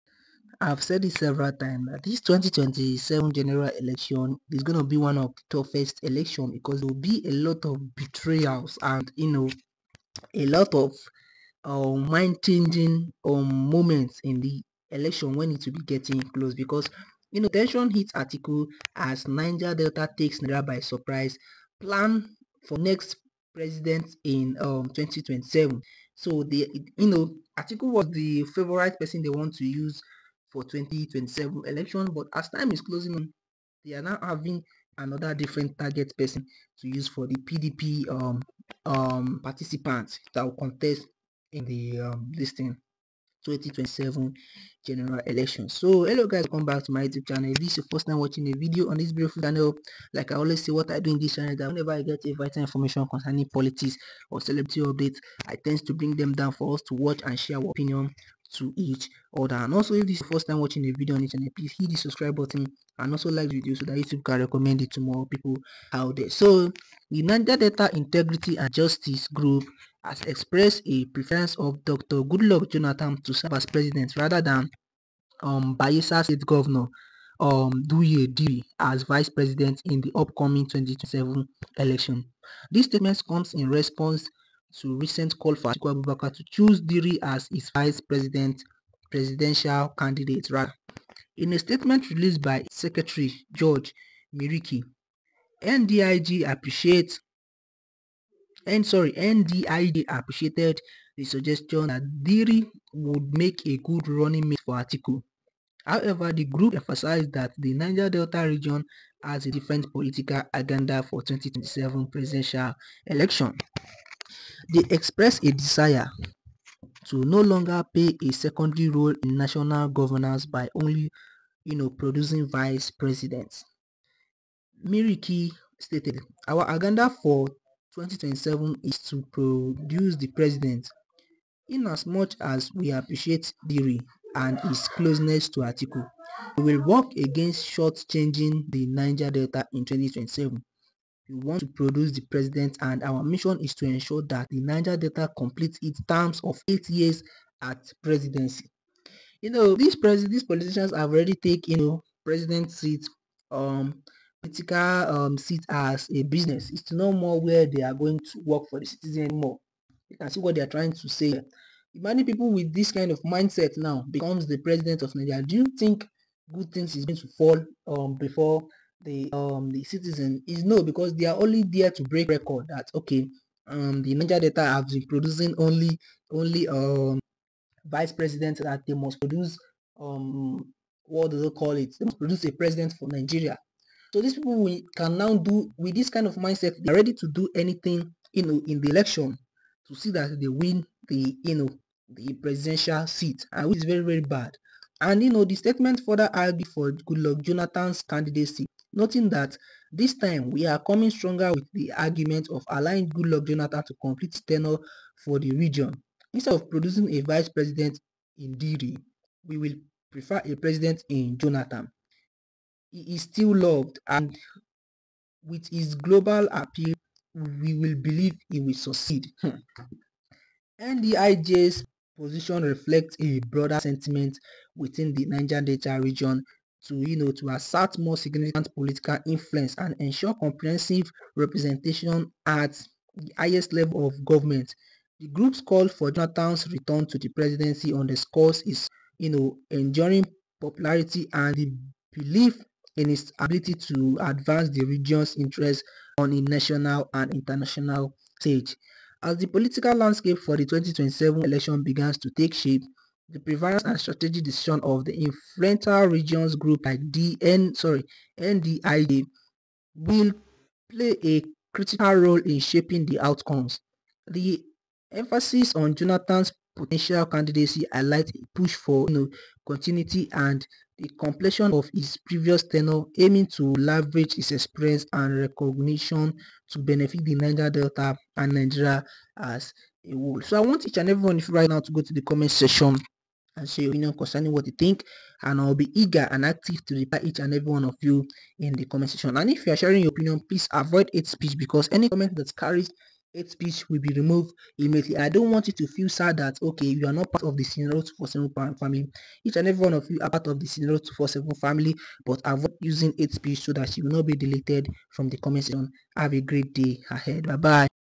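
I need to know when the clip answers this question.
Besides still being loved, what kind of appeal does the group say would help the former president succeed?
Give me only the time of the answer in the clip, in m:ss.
3:35.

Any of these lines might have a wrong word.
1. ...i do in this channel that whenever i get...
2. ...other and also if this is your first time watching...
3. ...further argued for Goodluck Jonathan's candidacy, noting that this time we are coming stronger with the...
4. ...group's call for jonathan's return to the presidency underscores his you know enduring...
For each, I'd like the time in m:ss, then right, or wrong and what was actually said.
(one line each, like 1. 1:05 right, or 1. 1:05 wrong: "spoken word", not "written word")
1. 0:50 right
2. 0:59 right
3. 3:16 right
4. 3:55 right.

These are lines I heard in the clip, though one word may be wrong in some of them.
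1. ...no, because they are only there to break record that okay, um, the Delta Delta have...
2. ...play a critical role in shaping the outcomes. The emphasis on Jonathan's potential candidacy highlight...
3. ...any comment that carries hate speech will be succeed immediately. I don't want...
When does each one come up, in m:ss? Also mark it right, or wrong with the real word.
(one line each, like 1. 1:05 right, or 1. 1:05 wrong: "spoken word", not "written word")
1. 2:50 wrong: "Niger", not "Delta"
2. 4:20 right
3. 4:51 wrong: "removed", not "succeed".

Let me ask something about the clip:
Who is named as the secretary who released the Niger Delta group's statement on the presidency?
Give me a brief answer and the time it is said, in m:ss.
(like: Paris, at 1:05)
George Miriki, at 1:33.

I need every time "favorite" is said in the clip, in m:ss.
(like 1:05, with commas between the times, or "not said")
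0:28.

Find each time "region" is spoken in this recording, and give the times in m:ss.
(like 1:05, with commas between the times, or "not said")
1:48, 3:25, 3:46, 4:04, 4:16.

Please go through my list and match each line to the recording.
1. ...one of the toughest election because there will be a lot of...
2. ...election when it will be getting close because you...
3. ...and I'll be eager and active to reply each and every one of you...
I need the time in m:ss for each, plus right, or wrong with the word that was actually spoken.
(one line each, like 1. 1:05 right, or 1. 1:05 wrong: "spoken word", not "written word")
1. 0:04 right
2. 0:14 right
3. 4:45 right.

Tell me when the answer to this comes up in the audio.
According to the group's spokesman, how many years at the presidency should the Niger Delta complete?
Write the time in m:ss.
2:26.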